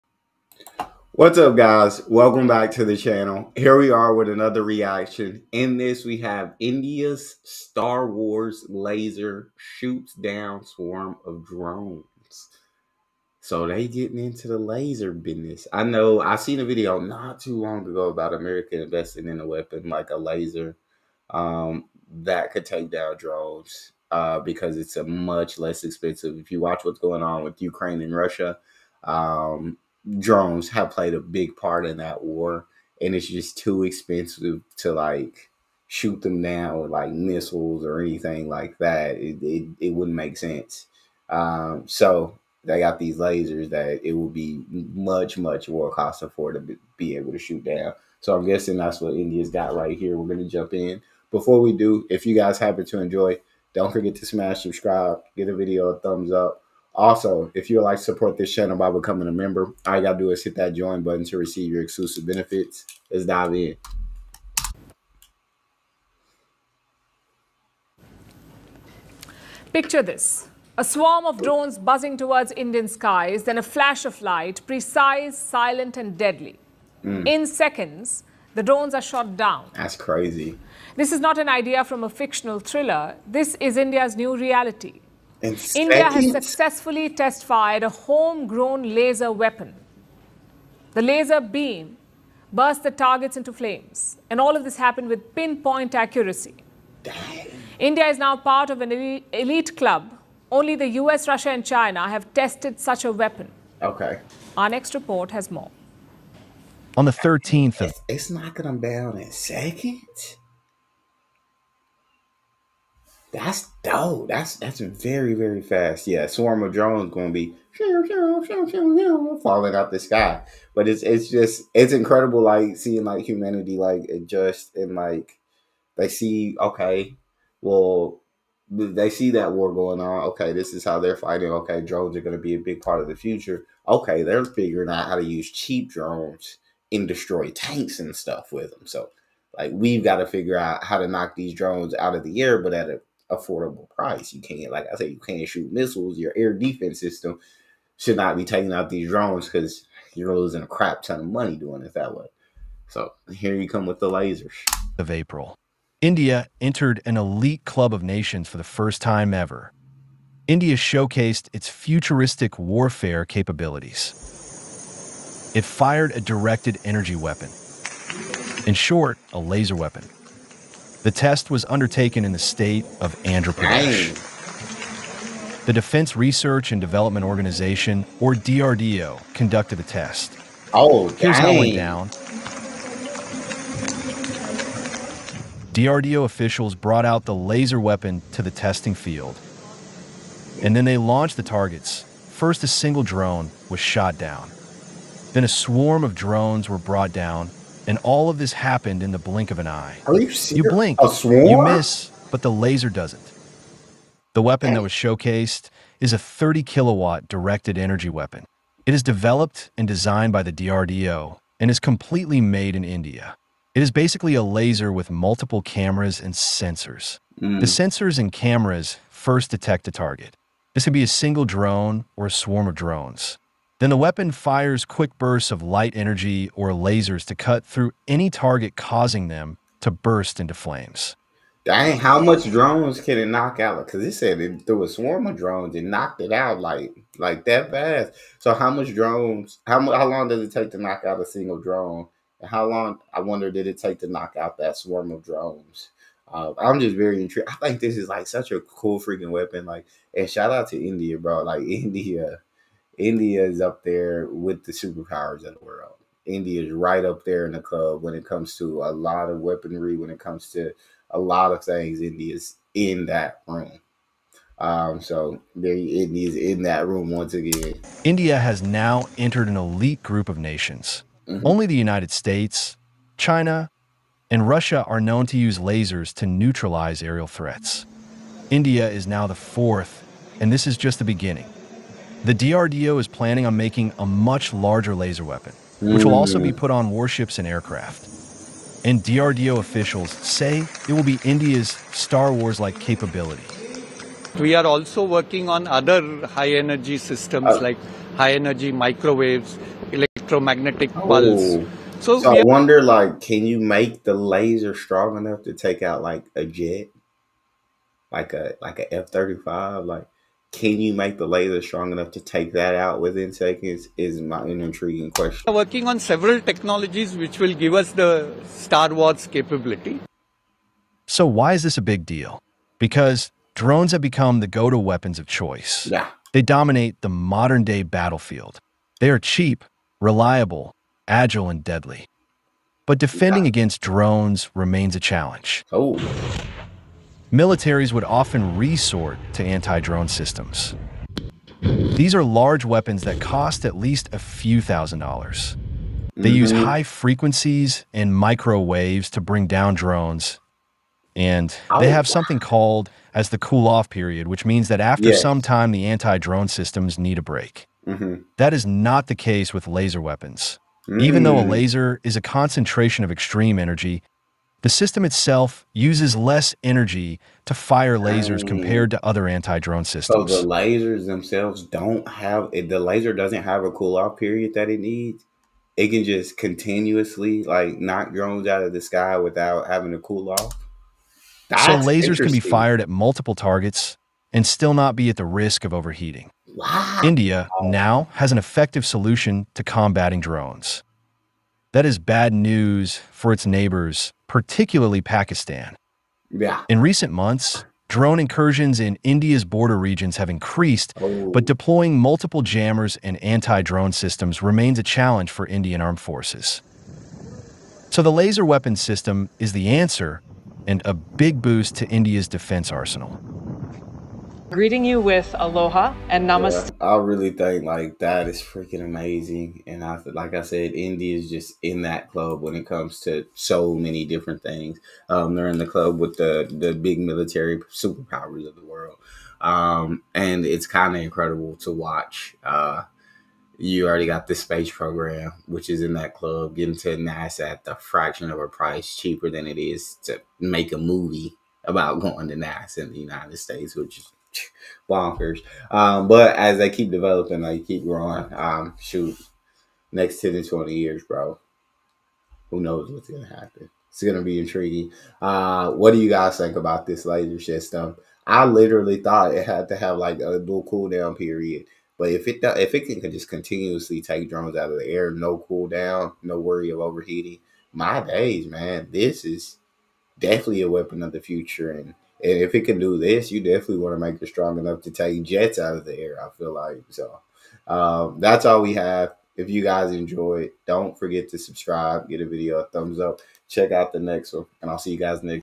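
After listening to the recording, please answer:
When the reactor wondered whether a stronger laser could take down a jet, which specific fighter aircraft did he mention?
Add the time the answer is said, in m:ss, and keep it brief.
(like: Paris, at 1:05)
F-35, at 5:08.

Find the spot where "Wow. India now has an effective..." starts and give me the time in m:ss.
6:26.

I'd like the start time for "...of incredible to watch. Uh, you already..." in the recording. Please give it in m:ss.
7:10.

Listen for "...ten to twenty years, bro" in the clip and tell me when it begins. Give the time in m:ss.
7:30.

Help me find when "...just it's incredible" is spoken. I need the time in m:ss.
2:01.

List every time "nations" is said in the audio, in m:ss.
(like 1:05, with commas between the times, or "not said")
2:38, 4:30.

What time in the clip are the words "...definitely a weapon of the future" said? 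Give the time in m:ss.
7:50.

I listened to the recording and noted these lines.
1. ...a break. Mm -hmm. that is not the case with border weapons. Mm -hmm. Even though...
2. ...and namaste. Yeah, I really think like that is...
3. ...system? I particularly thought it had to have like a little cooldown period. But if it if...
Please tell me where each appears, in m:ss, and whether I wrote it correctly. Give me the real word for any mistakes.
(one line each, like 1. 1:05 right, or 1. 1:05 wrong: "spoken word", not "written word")
1. 5:57 wrong: "laser", not "border"
2. 6:56 right
3. 7:37 wrong: "literally", not "particularly".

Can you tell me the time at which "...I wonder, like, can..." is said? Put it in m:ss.
5:02.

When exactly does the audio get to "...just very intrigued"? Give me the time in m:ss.
4:06.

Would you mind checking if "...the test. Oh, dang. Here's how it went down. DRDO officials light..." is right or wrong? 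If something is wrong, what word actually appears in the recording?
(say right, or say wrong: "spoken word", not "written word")
wrong: "brought", not "light".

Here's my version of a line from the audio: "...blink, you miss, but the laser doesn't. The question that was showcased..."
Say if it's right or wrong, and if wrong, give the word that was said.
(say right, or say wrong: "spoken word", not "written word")
wrong: "weapon", not "question".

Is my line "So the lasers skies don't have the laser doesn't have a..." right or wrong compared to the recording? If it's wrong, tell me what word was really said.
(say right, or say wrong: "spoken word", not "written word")
wrong: "themselves", not "skies".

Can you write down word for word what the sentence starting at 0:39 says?
It it, it wouldn't make sense.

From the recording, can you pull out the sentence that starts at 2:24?
You can't, like I said, you can't shoot missiles.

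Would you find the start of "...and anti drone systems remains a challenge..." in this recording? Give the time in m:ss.
6:43.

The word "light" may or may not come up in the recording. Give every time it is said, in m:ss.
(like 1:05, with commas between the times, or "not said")
1:14, 3:45.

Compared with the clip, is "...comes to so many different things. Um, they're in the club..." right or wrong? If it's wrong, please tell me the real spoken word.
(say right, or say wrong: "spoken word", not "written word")
right.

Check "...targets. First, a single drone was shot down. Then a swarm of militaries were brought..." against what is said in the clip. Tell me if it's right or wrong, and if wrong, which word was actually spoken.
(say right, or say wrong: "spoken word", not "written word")
wrong: "drones", not "militaries".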